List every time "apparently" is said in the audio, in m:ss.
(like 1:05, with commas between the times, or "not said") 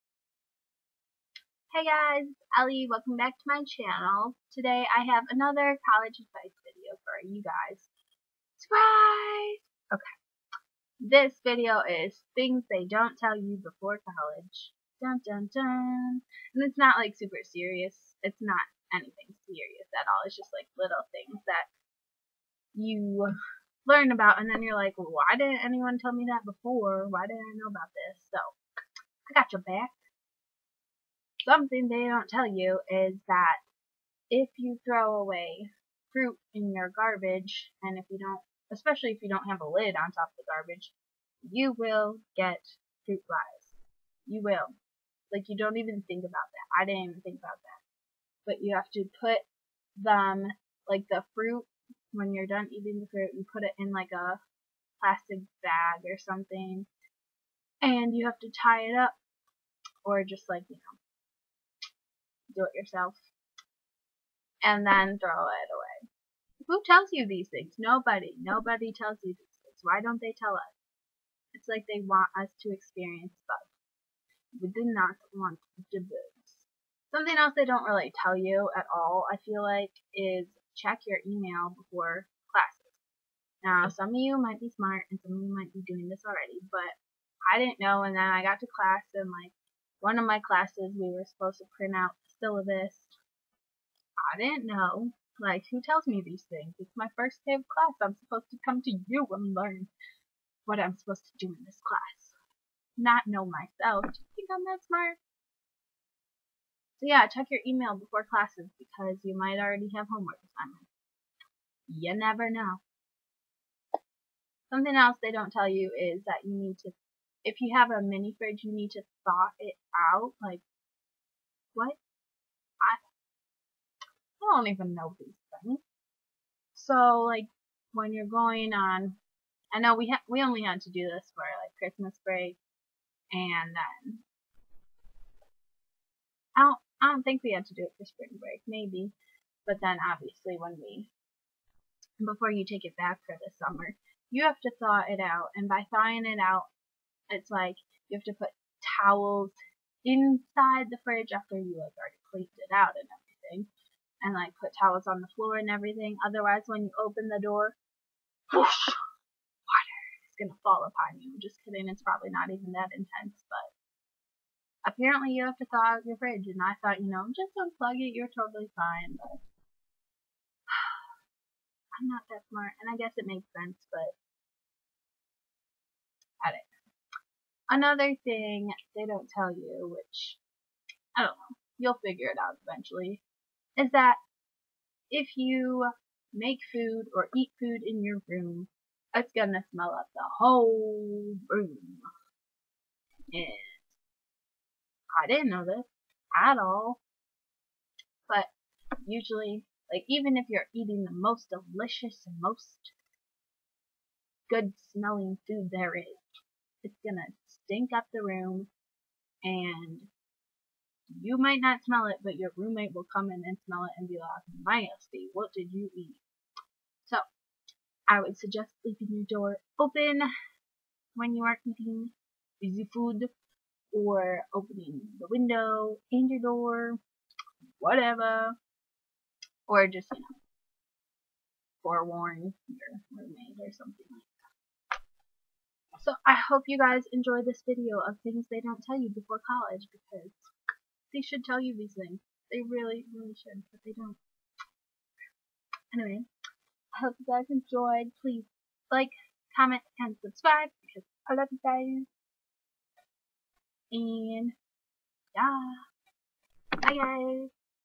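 2:44.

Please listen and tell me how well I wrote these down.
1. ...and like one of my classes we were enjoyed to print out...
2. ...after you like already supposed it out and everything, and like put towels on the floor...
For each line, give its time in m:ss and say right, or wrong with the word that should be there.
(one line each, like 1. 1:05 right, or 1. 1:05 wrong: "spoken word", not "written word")
1. 1:29 wrong: "supposed", not "enjoyed"
2. 2:31 wrong: "cleaned", not "supposed".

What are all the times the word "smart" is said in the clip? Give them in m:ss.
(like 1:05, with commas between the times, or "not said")
1:24, 1:44, 2:52.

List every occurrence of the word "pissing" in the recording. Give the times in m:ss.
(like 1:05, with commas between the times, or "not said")
not said.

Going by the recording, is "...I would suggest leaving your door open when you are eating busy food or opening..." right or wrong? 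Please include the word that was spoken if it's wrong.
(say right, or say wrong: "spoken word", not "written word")
right.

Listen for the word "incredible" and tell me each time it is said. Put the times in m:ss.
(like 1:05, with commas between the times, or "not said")
not said.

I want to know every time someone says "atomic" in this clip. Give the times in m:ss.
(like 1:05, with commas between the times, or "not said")
not said.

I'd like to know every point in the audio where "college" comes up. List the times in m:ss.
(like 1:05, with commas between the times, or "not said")
0:05, 0:14, 3:59.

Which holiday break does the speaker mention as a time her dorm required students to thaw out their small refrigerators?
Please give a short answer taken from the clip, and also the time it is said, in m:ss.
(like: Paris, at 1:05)
Christmas break, at 2:11.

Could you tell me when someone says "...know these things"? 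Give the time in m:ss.
2:04.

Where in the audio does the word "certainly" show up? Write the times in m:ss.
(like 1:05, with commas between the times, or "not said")
not said.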